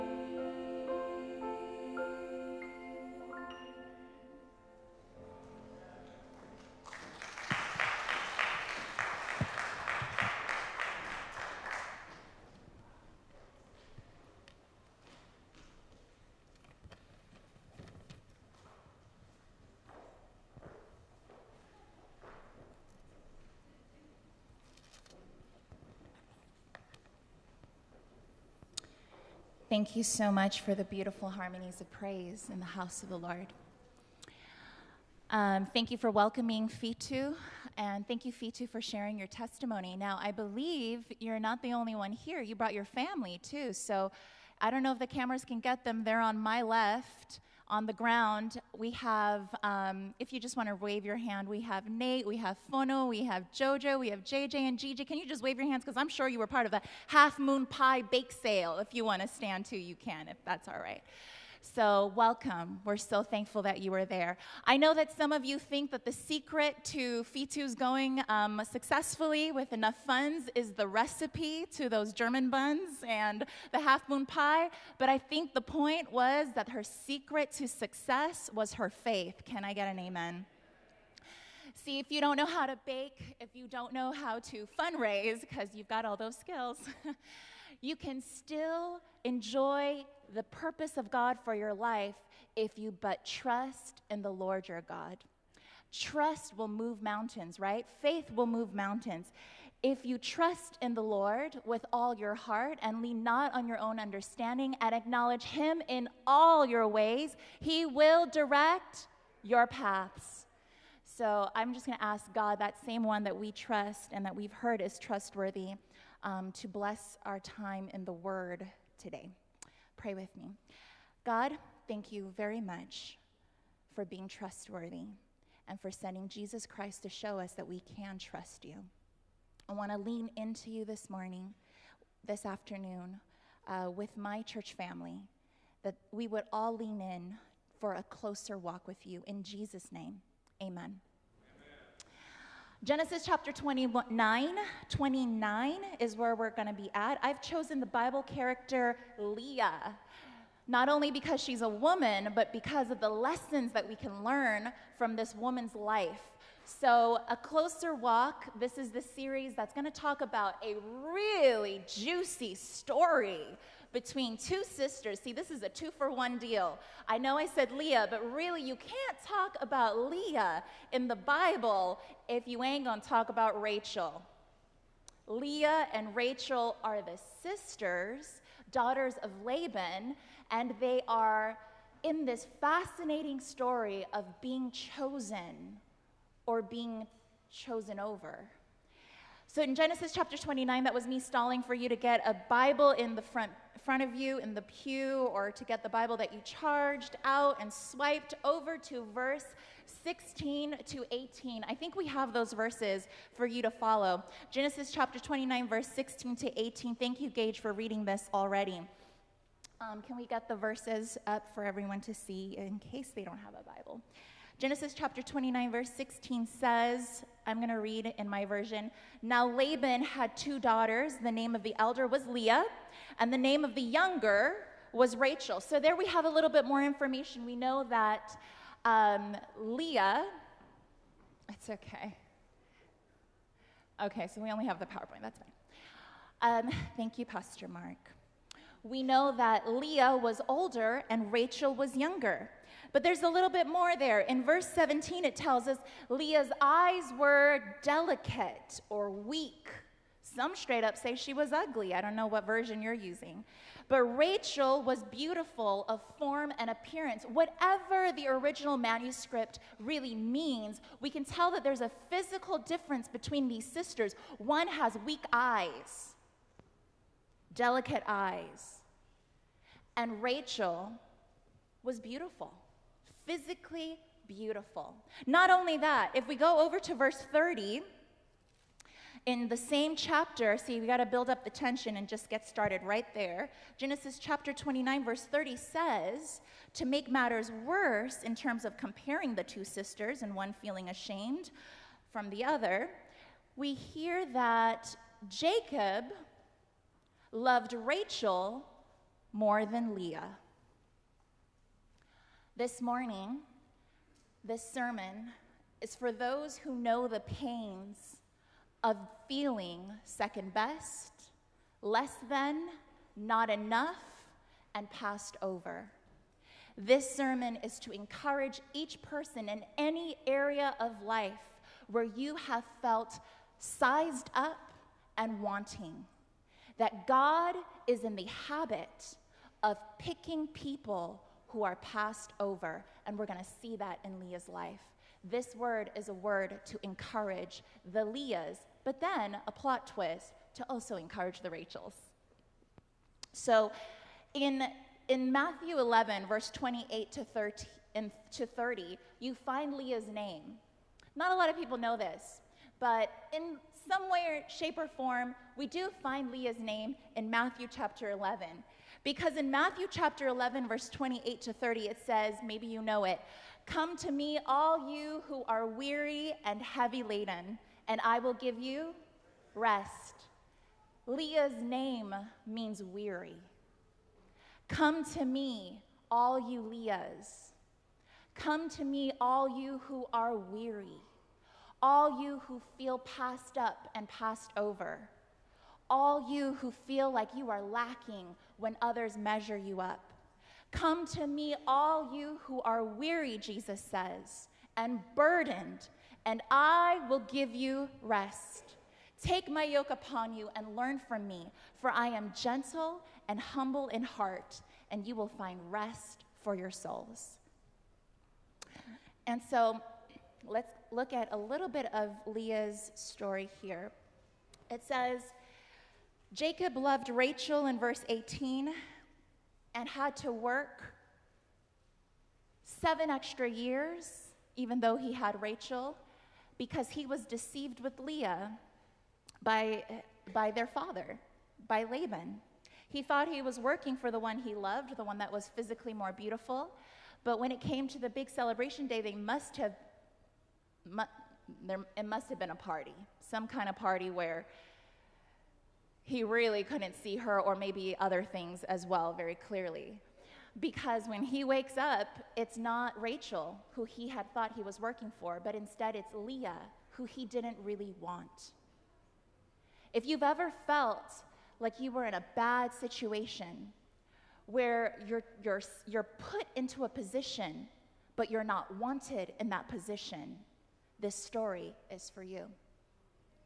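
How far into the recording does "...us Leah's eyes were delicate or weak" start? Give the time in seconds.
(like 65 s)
245 s.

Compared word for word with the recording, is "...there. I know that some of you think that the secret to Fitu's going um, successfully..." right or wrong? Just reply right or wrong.
right.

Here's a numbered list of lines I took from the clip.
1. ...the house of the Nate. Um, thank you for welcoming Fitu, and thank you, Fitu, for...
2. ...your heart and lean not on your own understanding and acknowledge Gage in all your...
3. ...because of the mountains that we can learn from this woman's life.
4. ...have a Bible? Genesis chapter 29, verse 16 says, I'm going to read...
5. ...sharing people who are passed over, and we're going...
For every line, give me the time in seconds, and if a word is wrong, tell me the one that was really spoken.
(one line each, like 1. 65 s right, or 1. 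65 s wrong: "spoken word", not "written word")
1. 32 s wrong: "Lord", not "Nate"
2. 102 s wrong: "Him", not "Gage"
3. 152 s wrong: "lessons", not "mountains"
4. 213 s right
5. 329 s wrong: "picking", not "sharing".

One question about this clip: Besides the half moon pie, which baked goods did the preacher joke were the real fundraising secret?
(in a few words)
German buns.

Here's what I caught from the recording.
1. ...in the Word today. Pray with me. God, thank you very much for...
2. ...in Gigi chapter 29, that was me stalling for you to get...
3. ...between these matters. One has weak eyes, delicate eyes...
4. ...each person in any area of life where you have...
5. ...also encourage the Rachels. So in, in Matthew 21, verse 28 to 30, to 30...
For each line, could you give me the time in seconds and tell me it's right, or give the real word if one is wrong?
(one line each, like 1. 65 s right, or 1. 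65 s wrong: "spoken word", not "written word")
1. 117 s right
2. 189 s wrong: "Genesis", not "Gigi"
3. 263 s wrong: "sisters", not "matters"
4. 318 s right
5. 340 s wrong: "11", not "21".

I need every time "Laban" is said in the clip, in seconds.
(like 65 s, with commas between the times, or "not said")
179 s, 219 s, 431 s.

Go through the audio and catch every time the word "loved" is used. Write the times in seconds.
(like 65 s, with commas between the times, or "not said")
297 s, 416 s, 434 s.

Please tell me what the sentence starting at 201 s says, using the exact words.
I think we have those verses for you to follow.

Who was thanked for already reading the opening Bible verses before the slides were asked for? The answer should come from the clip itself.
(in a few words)
Gage.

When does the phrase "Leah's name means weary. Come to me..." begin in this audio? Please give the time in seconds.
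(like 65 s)
371 s.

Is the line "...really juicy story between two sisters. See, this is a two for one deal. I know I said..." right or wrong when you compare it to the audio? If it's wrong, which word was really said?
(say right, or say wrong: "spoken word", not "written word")
right.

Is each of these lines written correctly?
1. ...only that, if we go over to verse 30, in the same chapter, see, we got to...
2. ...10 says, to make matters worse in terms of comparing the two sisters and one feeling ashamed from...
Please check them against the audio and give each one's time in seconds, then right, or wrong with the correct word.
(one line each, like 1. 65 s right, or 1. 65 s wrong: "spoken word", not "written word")
1. 275 s right
2. 285 s wrong: "30", not "10".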